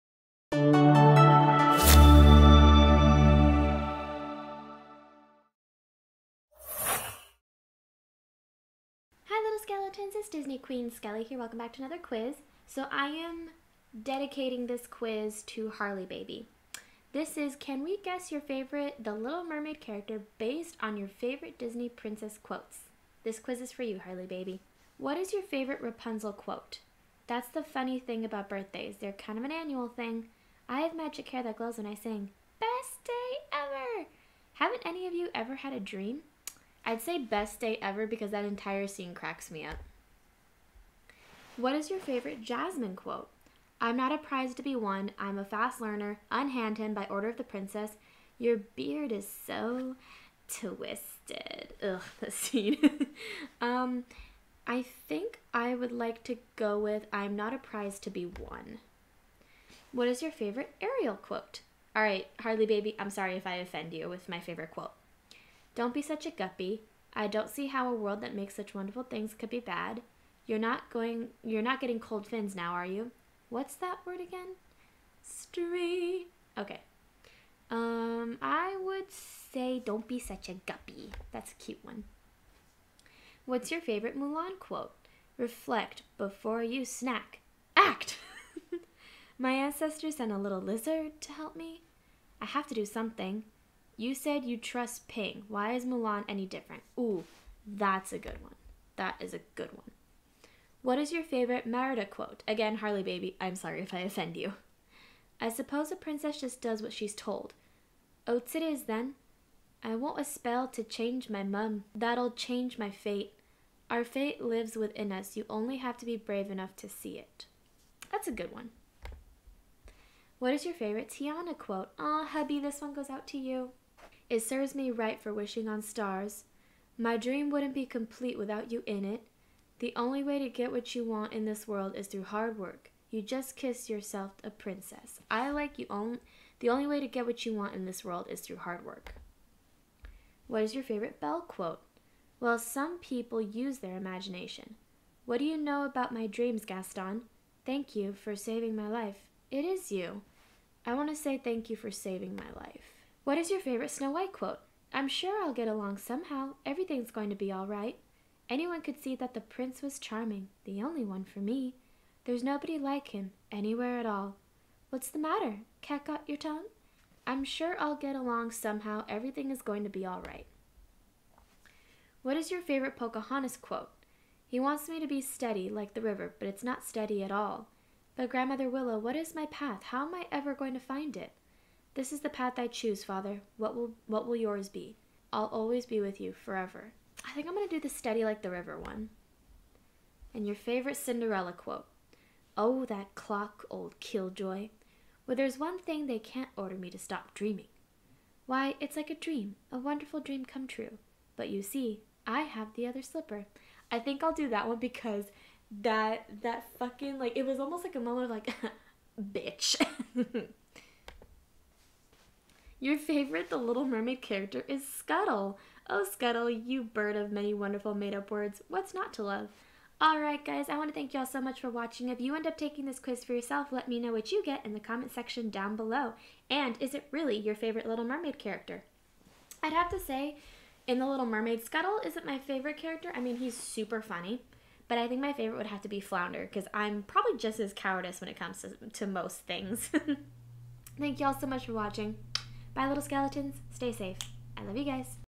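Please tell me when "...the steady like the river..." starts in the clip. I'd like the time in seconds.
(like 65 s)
187 s.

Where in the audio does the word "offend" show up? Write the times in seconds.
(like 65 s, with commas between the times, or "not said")
63 s, 103 s.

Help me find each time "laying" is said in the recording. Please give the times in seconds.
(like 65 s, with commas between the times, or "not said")
not said.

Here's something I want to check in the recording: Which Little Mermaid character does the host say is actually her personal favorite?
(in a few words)
Flounder.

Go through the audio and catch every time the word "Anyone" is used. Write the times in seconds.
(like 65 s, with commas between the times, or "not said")
158 s.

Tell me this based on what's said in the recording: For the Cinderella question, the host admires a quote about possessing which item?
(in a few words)
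the other slipper.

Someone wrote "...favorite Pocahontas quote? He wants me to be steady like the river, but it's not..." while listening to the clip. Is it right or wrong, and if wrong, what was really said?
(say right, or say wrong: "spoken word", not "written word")
right.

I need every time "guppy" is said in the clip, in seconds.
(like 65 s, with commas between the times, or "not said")
66 s, 80 s.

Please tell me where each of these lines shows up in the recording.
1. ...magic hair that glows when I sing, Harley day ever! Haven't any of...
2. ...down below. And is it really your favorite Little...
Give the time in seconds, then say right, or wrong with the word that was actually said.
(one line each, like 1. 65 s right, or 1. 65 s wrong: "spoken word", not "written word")
1. 30 s wrong: "Best", not "Harley"
2. 225 s right.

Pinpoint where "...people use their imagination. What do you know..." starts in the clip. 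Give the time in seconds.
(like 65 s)
142 s.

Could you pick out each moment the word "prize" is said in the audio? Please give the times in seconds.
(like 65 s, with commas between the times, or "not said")
44 s, 57 s.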